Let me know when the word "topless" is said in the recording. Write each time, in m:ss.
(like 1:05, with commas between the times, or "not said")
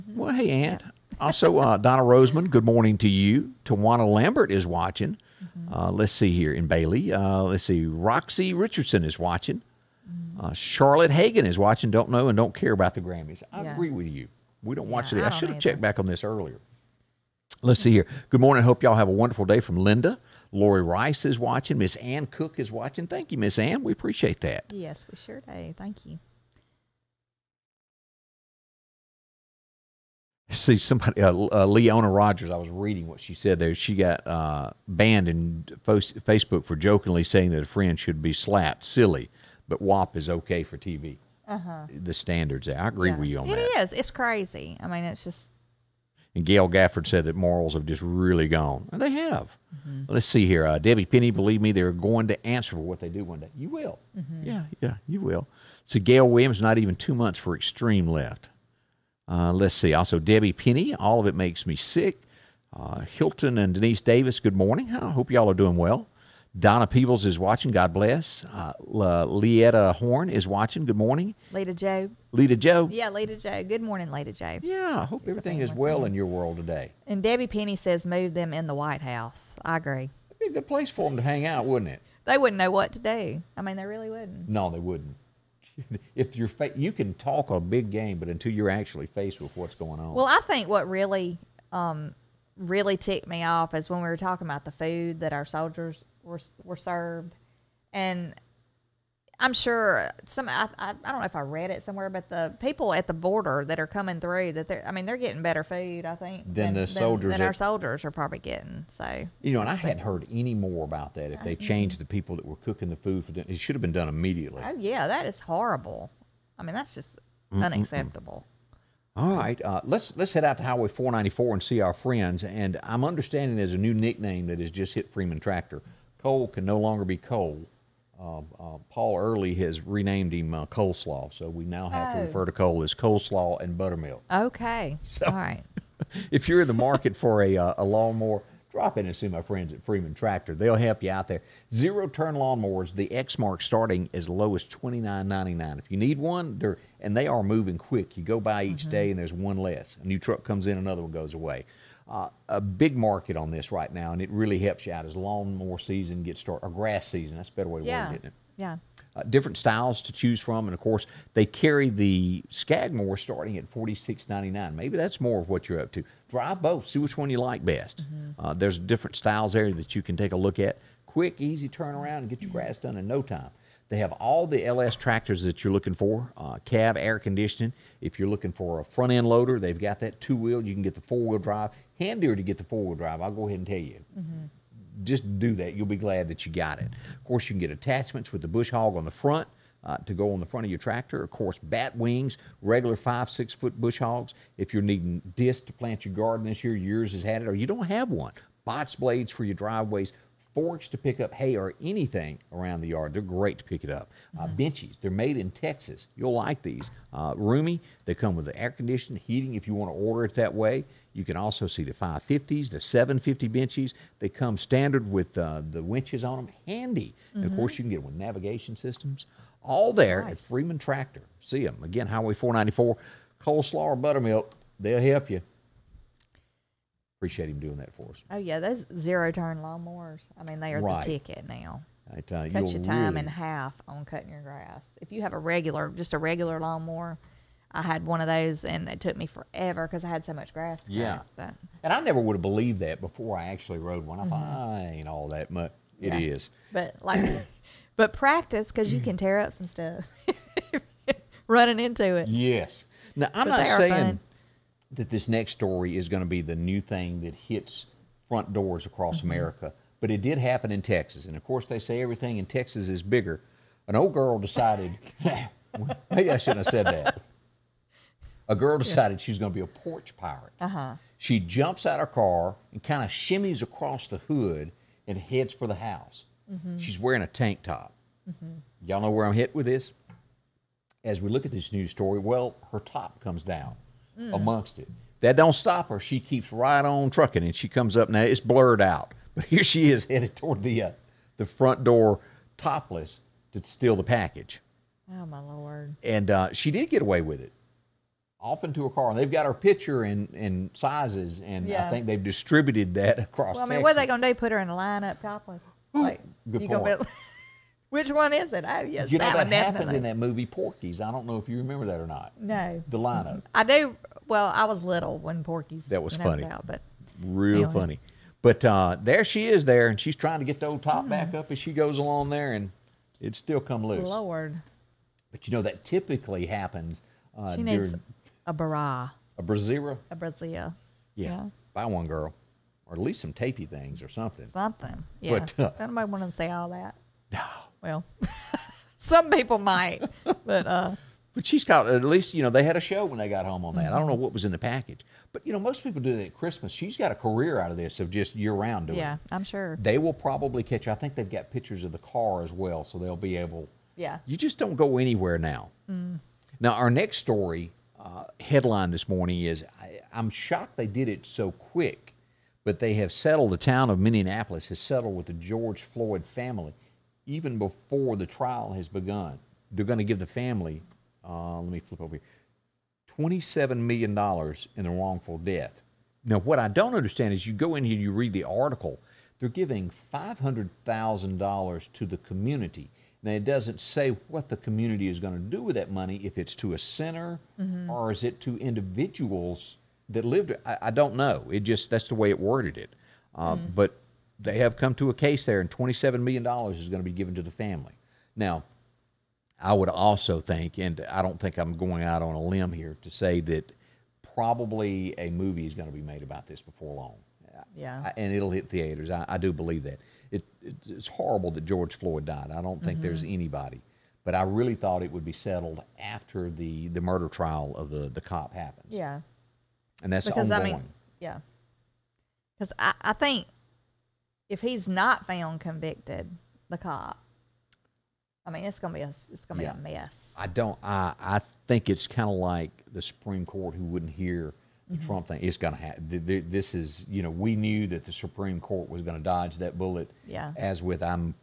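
4:52, 5:05.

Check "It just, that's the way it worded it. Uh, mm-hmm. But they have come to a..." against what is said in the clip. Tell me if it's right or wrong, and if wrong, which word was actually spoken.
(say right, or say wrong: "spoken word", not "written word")
right.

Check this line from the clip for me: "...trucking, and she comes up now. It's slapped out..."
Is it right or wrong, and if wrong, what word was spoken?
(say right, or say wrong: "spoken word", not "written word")
wrong: "blurred", not "slapped".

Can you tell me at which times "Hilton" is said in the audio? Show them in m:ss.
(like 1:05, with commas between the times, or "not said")
1:03.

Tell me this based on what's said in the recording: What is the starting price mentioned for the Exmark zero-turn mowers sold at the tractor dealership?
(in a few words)
2,999.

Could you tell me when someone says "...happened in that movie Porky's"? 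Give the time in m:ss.
5:09.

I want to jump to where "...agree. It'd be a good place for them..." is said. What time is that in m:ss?
1:19.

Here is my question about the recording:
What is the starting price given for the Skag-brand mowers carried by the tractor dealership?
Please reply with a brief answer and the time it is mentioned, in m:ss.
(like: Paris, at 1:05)
4,699, at 2:43.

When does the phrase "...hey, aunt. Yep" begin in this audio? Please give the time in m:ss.
0:00.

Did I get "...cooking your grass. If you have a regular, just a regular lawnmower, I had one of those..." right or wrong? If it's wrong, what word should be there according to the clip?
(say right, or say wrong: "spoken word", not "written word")
wrong: "cutting", not "cooking".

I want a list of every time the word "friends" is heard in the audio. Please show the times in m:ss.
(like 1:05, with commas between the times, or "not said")
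0:37, 2:01, 2:19.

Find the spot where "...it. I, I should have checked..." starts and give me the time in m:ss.
0:15.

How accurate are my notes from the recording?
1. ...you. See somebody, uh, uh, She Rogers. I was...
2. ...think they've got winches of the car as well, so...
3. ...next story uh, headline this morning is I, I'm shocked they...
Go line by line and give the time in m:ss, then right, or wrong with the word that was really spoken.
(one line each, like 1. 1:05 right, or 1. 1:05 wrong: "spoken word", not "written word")
1. 0:26 wrong: "Leona", not "She"
2. 5:50 wrong: "pictures", not "winches"
3. 5:56 right.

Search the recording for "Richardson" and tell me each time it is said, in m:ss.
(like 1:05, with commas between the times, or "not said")
0:08.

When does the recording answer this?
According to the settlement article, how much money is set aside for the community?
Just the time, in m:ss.
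6:19.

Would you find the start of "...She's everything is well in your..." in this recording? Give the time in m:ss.
1:15.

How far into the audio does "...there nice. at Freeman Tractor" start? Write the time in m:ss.
3:39.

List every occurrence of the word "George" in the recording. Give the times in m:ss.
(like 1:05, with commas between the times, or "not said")
6:05, 6:51.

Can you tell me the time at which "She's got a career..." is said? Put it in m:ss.
5:46.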